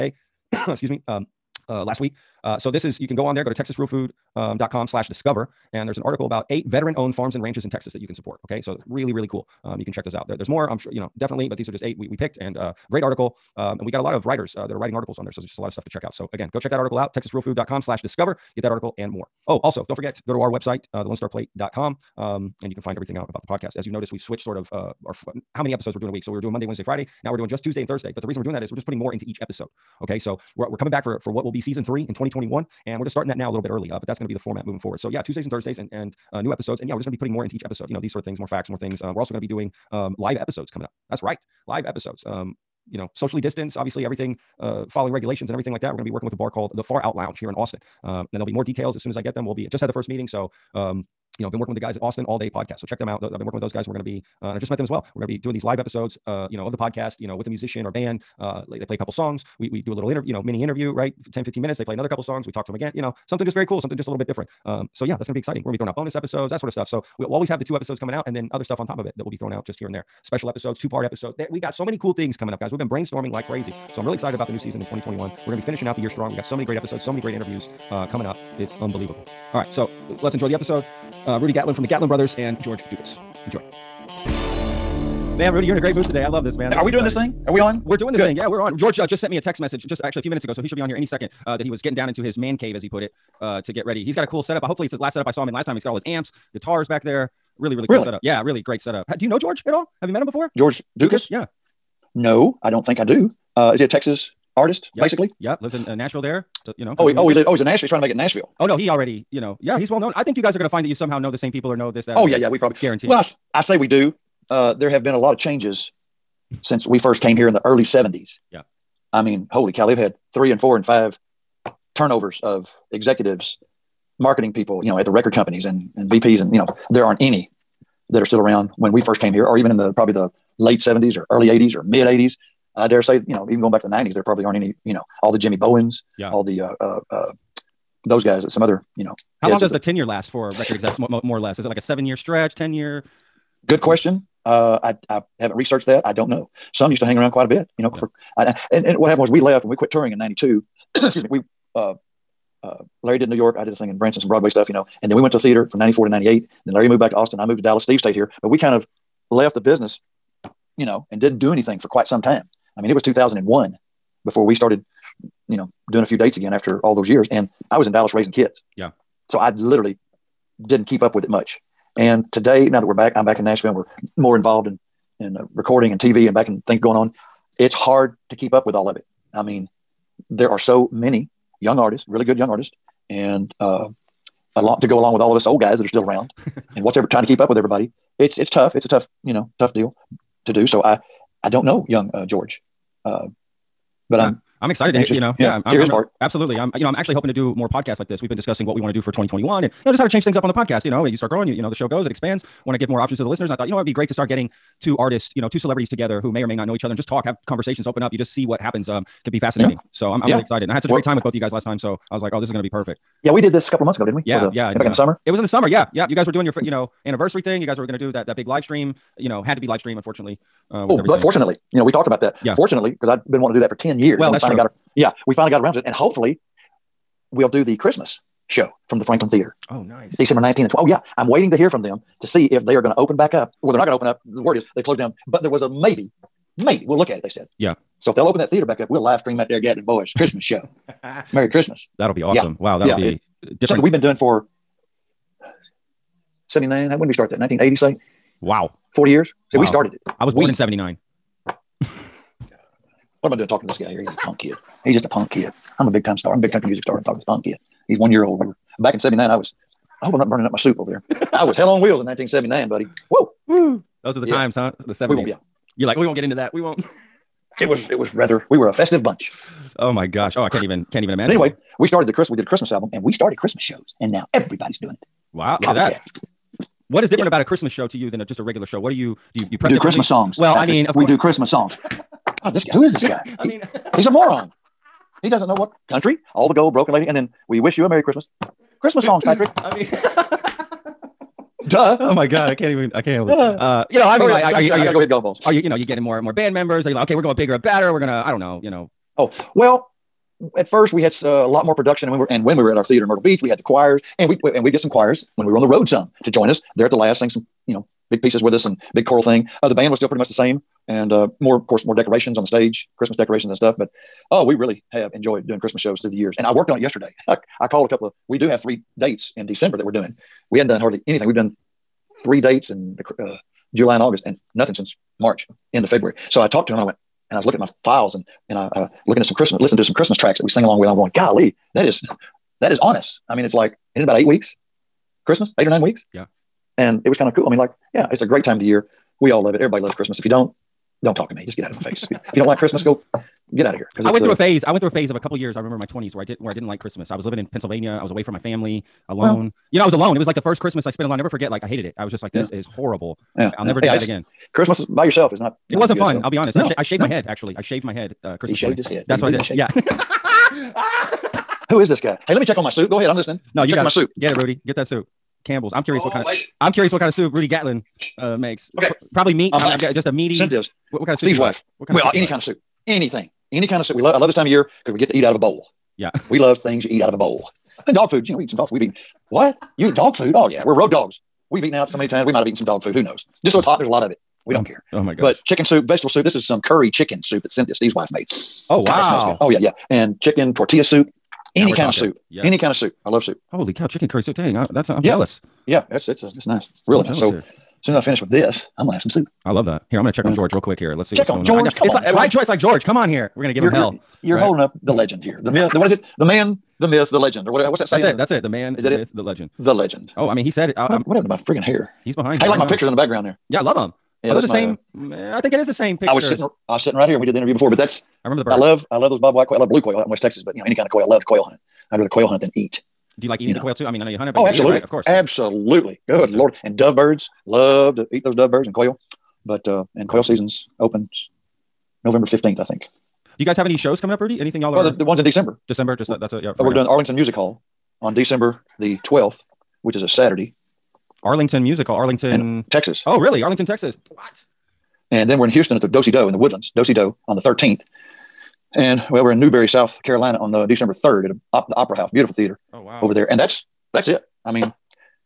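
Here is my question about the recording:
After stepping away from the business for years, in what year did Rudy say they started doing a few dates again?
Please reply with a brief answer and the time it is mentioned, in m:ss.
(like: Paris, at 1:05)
2001, at 2:43.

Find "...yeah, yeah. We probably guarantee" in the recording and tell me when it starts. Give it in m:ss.
1:52.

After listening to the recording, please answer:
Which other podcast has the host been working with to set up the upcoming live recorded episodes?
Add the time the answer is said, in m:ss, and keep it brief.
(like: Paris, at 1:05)
Austin All Day Podcast, at 0:52.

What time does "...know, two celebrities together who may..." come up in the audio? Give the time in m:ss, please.
3:25.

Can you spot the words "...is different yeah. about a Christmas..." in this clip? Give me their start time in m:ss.
4:37.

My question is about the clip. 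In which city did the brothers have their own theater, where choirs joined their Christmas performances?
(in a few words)
Myrtle Beach.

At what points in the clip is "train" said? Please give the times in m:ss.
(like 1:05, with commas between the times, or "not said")
not said.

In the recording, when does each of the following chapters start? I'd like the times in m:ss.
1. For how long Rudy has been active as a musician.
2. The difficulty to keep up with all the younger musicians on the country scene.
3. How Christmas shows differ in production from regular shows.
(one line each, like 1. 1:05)
1. 1:41
2. 2:52
3. 4:49.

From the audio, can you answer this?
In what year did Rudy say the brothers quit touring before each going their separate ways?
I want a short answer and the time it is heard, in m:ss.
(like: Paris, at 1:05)
1992, at 2:30.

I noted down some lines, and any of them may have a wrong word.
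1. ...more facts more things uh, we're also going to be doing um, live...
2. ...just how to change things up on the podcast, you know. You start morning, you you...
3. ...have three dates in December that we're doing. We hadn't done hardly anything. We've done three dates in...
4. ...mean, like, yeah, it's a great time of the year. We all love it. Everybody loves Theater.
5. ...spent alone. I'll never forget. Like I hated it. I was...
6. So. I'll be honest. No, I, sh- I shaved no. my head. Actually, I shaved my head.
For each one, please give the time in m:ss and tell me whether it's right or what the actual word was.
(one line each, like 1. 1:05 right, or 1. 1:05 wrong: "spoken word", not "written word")
1. 0:38 right
2. 3:19 wrong: "growing", not "morning"
3. 5:18 right
4. 5:37 wrong: "Christmas", not "Theater"
5. 5:50 right
6. 5:56 right.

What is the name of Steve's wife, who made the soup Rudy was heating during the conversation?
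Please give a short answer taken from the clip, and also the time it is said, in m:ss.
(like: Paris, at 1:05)
Cynthia, at 6:27.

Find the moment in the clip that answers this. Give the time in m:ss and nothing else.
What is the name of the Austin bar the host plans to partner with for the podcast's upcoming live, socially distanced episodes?
0:46.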